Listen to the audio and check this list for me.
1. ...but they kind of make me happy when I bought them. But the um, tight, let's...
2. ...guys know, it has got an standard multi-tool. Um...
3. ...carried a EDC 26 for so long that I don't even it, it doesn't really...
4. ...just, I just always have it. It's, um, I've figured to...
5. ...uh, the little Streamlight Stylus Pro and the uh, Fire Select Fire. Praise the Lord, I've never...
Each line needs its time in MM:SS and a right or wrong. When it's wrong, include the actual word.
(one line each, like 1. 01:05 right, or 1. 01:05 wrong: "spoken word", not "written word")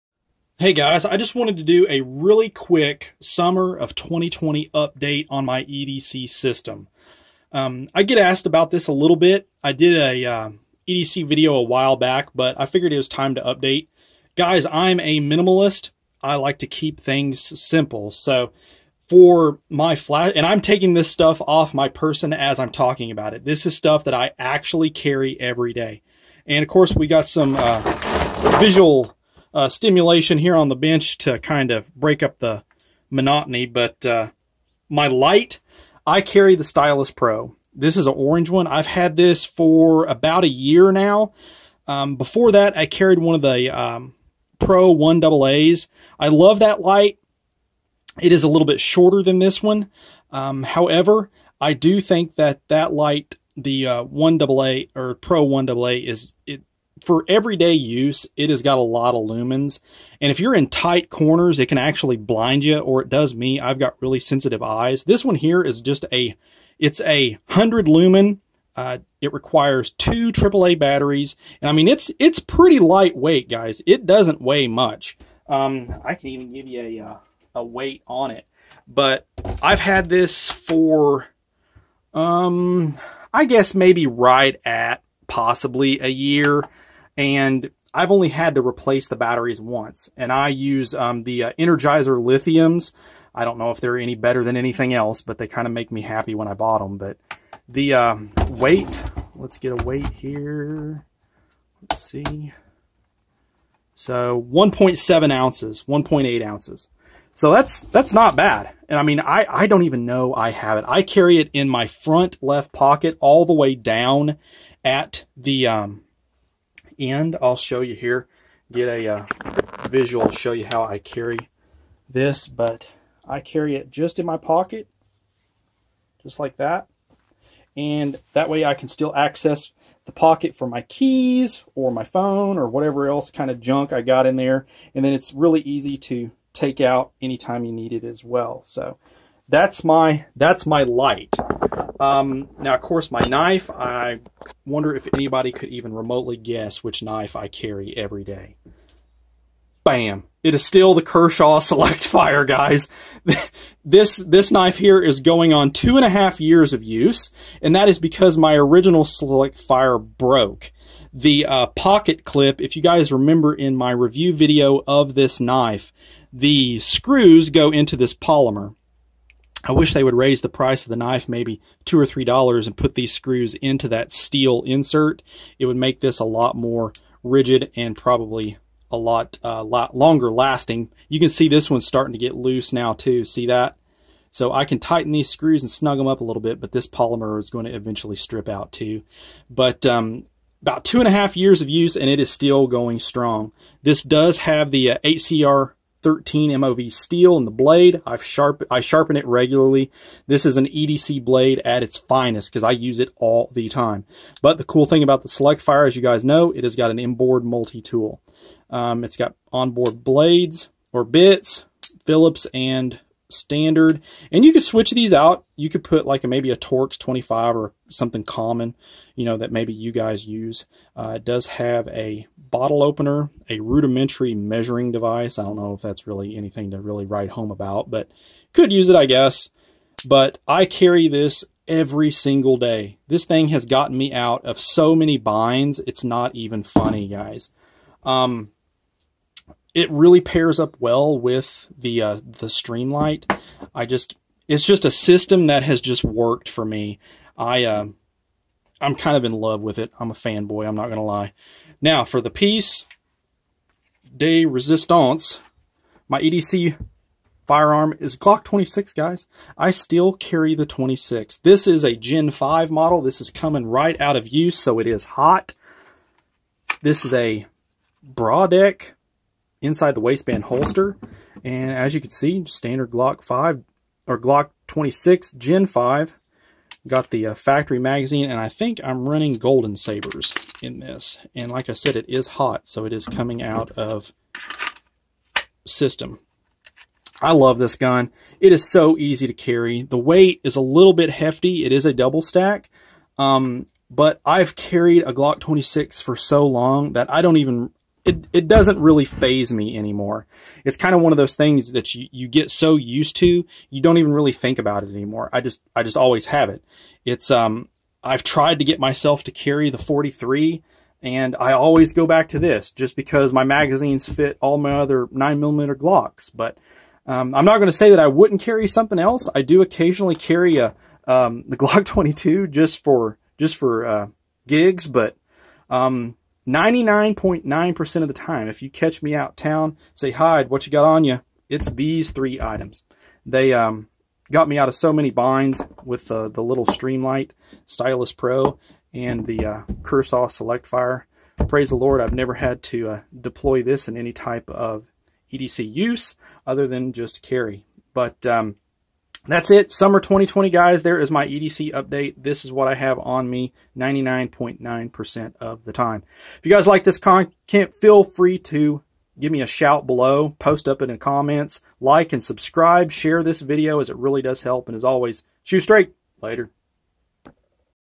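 1. 01:35 wrong: "weight", not "tight"
2. 03:26 wrong: "inboard", not "standard"
3. 04:54 wrong: "Glock", not "EDC"
4. 05:05 wrong: "tried", not "figured"
5. 05:36 wrong: "Kershaw", not "Fire".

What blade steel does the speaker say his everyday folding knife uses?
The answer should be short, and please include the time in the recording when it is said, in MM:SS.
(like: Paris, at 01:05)
8CR13MOV, at 03:15.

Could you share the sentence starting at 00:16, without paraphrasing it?
I like to keep things simple.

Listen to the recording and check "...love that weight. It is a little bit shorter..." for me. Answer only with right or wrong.
wrong.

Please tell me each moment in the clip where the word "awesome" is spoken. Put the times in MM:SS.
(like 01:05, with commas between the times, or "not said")
not said.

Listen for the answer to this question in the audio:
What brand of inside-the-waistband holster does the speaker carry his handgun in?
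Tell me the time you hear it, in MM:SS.
04:28.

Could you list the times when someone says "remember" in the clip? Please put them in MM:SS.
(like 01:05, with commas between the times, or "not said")
02:43.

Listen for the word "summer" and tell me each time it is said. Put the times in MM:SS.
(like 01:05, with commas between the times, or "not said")
00:03, 05:49.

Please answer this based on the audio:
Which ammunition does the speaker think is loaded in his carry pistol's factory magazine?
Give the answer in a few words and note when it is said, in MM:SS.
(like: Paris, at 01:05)
Golden Sabers, at 04:39.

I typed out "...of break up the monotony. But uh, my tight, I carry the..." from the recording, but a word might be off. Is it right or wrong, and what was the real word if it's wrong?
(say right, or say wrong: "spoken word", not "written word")
wrong: "light", not "tight".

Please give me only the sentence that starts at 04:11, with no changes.
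Now for the piece de resistance, my EDC firearm is Glock 26, guys.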